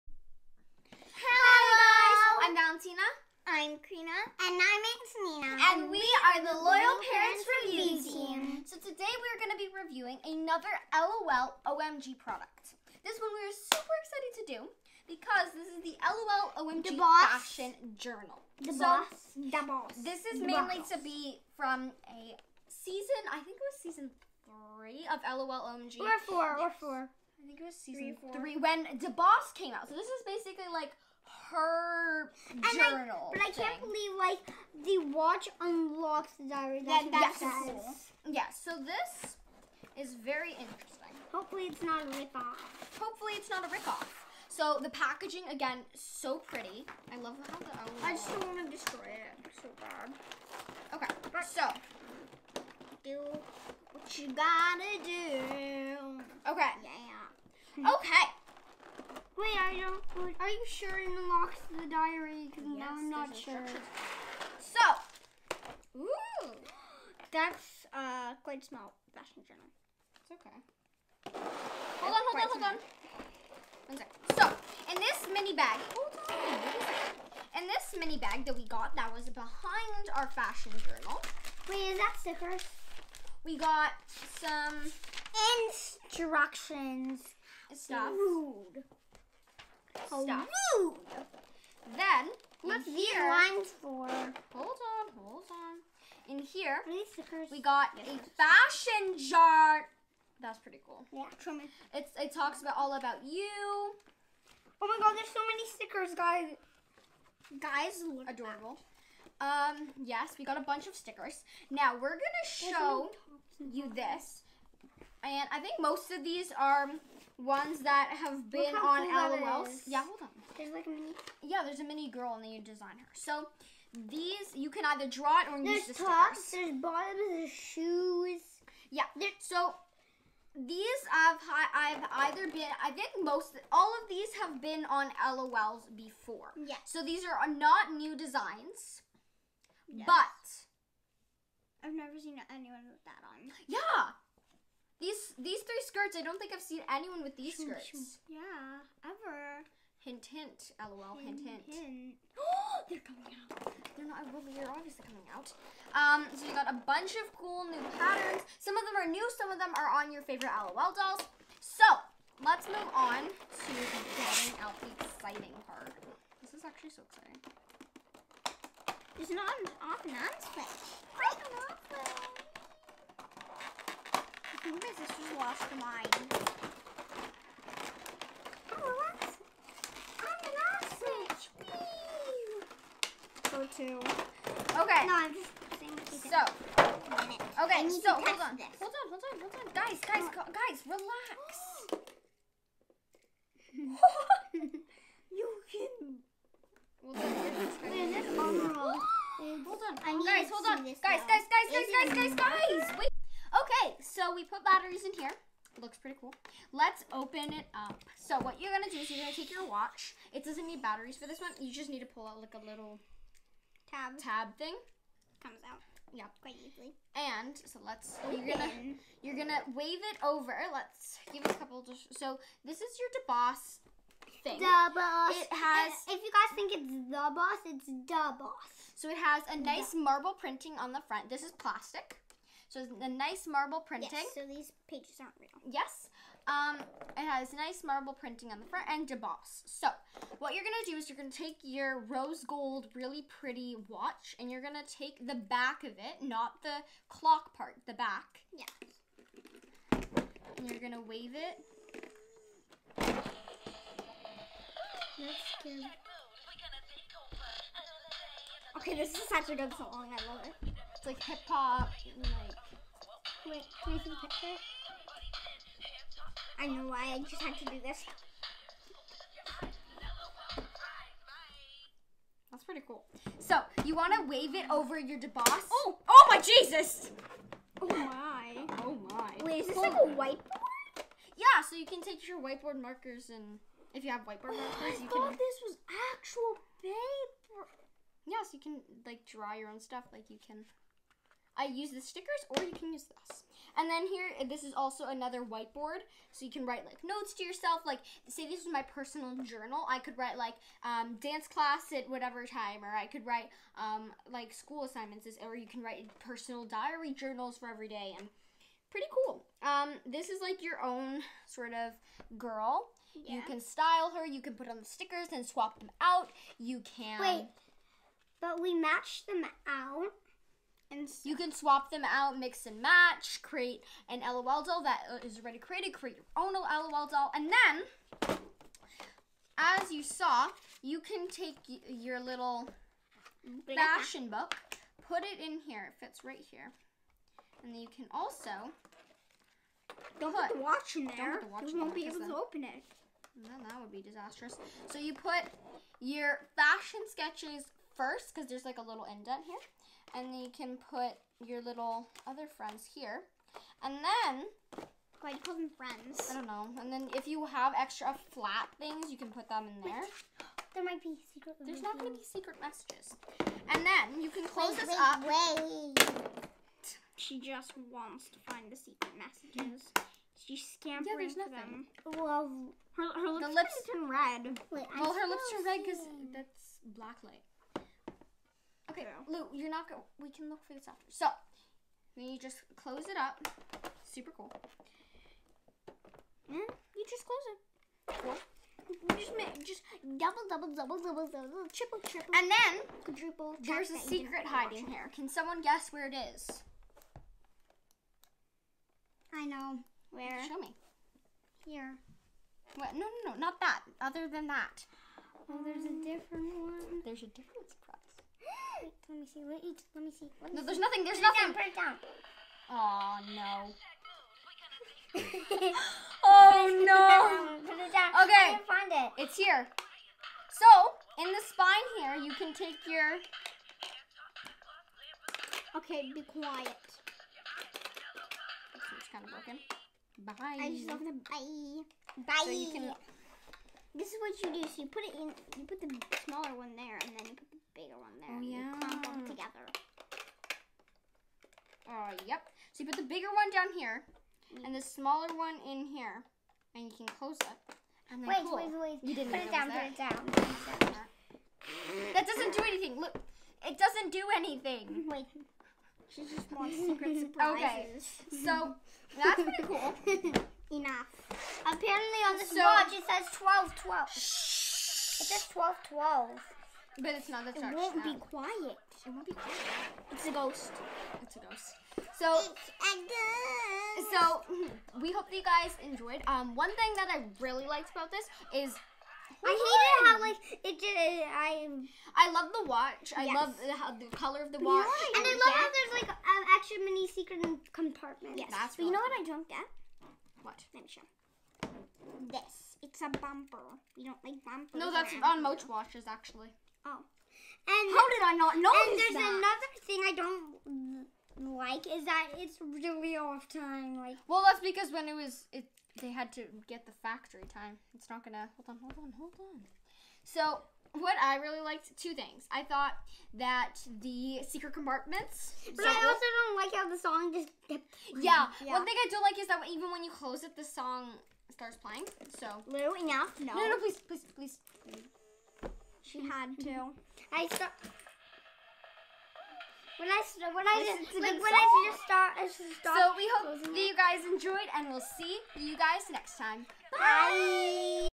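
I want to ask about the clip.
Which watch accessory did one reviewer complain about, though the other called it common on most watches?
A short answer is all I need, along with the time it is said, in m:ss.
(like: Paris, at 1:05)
A bumper, at 8:13.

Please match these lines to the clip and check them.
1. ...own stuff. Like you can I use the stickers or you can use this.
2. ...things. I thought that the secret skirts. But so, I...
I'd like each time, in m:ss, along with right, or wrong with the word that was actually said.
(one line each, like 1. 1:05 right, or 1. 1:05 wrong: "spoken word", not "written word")
1. 4:49 right
2. 8:32 wrong: "compartments", not "skirts".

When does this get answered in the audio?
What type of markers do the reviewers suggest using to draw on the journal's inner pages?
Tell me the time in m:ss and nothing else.
4:42.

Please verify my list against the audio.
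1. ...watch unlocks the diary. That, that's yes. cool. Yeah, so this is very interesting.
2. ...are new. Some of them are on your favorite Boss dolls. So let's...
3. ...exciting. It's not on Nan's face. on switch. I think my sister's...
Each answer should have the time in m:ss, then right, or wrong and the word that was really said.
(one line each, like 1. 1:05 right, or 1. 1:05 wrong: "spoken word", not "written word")
1. 0:35 right
2. 2:39 wrong: "LOL", not "Boss"
3. 2:47 right.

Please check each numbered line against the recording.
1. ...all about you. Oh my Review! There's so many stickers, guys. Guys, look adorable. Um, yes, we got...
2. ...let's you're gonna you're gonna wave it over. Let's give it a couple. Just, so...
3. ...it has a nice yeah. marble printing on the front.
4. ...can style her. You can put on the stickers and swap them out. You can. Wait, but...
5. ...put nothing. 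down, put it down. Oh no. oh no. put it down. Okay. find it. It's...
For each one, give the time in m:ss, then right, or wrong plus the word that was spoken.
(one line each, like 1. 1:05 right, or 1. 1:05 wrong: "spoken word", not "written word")
1. 1:42 wrong: "God", not "Review"
2. 3:37 right
3. 3:49 right
4. 5:13 right
5. 6:51 right.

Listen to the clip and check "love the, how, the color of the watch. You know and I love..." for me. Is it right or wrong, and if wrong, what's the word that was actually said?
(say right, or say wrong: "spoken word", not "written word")
right.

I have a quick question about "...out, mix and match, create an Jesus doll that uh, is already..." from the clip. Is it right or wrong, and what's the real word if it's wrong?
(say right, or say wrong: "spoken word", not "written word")
wrong: "LOL", not "Jesus".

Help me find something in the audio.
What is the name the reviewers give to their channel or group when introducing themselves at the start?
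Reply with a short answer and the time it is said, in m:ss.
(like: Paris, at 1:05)
Loyal Parents Review Team, at 0:06.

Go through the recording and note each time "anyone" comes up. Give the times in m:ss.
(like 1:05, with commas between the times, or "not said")
2:22, 2:26.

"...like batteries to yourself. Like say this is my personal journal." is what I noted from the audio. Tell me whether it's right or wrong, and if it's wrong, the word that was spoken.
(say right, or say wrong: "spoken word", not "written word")
wrong: "notes", not "batteries".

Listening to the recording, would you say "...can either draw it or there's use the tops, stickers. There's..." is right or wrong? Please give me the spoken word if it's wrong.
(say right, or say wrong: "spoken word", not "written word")
right.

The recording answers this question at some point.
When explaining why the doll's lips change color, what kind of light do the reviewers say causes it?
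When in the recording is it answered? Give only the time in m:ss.
6:16.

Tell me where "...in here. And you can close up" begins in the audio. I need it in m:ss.
7:25.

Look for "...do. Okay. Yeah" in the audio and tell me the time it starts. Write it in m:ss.
0:55.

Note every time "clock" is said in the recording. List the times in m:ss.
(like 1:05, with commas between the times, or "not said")
4:07.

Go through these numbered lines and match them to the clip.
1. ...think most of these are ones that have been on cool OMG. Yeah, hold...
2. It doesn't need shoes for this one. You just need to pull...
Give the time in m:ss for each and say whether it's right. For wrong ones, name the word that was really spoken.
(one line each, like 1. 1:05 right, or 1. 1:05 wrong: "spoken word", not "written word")
1. 1:55 wrong: "LOLs", not "OMG"
2. 3:30 wrong: "batteries", not "shoes".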